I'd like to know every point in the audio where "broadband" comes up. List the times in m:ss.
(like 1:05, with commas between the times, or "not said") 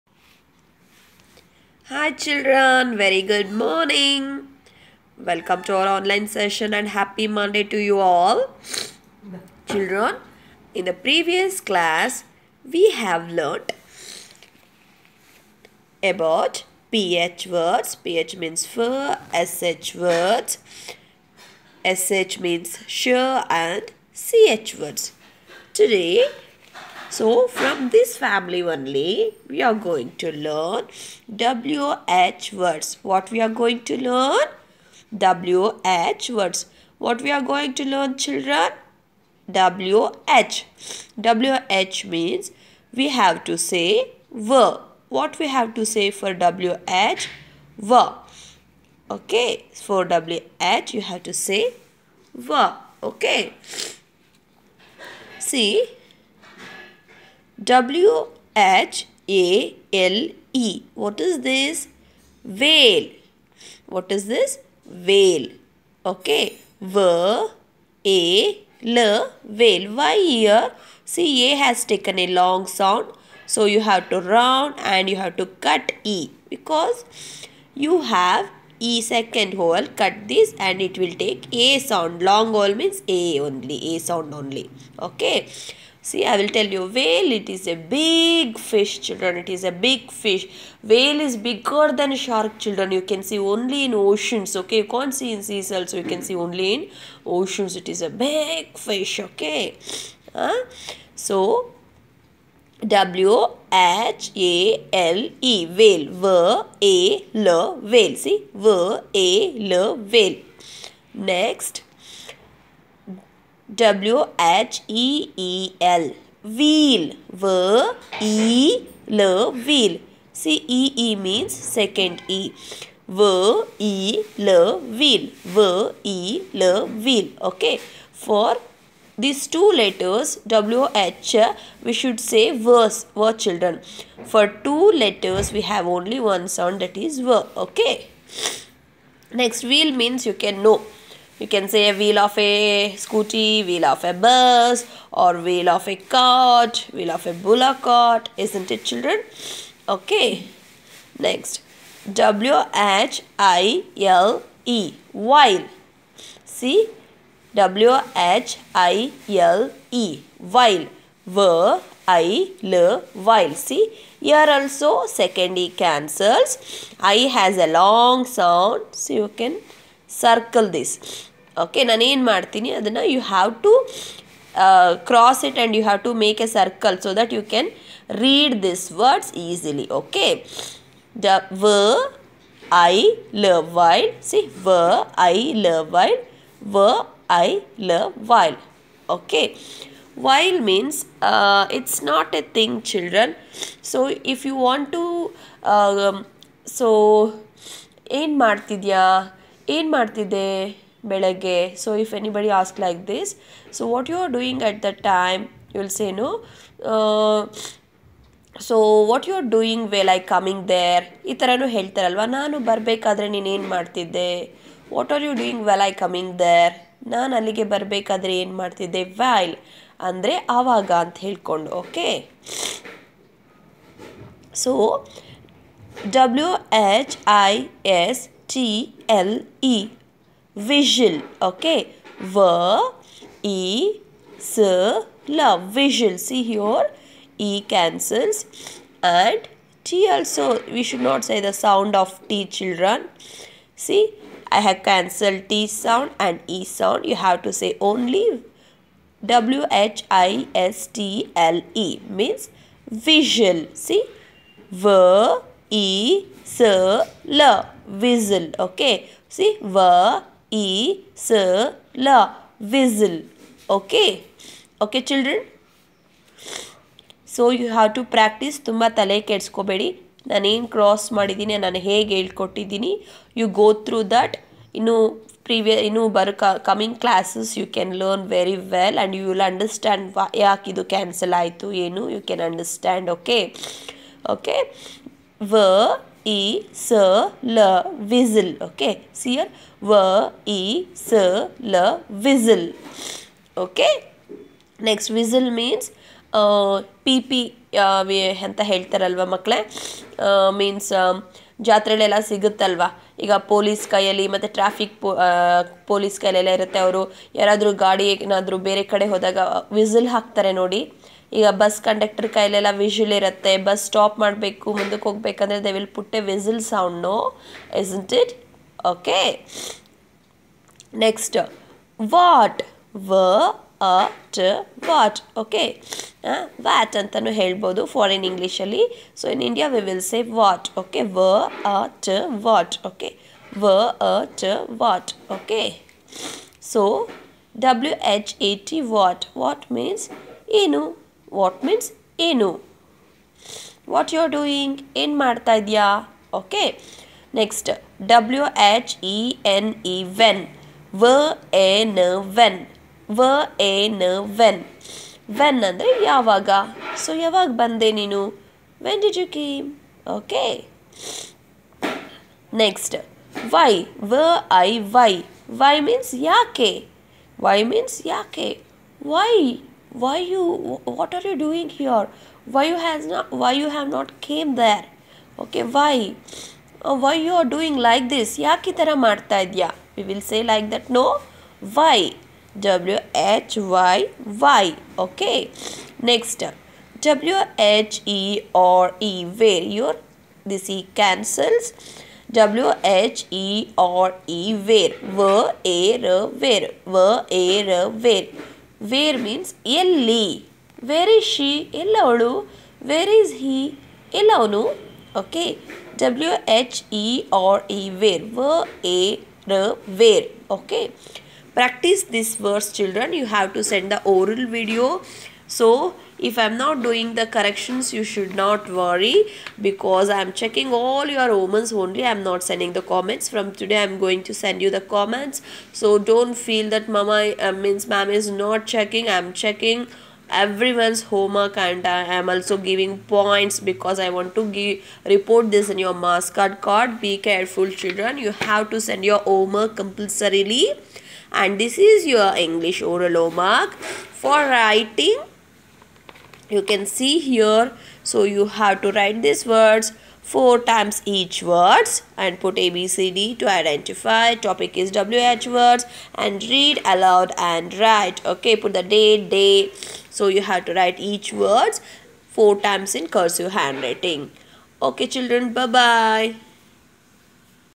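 not said.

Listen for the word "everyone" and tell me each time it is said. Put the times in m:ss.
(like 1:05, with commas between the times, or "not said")
7:10.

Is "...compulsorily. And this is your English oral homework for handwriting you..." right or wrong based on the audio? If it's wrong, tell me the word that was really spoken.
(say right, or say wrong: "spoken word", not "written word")
wrong: "writing", not "handwriting".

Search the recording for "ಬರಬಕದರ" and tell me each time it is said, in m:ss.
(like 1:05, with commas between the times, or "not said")
3:32, 3:37.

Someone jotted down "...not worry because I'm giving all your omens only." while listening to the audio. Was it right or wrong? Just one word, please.
wrong.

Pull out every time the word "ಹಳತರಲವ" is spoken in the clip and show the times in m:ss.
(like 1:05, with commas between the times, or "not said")
3:31, 4:58.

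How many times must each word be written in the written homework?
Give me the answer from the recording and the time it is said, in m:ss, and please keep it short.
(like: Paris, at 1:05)
4, at 7:30.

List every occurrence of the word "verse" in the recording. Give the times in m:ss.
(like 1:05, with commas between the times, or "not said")
2:12, 6:52.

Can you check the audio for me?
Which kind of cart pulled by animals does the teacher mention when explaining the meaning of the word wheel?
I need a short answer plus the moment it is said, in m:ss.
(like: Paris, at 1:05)
bullock cart, at 2:26.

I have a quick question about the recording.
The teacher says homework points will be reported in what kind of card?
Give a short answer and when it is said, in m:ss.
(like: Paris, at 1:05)
MasterCard, at 7:15.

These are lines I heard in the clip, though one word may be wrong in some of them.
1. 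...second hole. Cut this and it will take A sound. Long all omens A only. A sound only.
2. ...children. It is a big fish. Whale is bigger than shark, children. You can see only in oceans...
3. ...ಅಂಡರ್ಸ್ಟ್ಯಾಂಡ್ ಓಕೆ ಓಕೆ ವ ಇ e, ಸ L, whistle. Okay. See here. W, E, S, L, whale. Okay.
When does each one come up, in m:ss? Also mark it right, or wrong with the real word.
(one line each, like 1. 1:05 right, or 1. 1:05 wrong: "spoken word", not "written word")
1. 1:19 wrong: "means", not "omens"
2. 1:29 right
3. 4:42 wrong: "whistle", not "whale".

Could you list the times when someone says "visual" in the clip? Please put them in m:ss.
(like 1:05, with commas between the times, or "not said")
3:50, 3:55, 4:12, 4:17.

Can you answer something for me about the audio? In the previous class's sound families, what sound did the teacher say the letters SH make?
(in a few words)
sure.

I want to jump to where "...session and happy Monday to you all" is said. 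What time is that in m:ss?
0:06.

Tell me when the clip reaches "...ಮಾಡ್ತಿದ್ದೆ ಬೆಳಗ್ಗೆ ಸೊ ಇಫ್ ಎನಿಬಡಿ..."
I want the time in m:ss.
3:19.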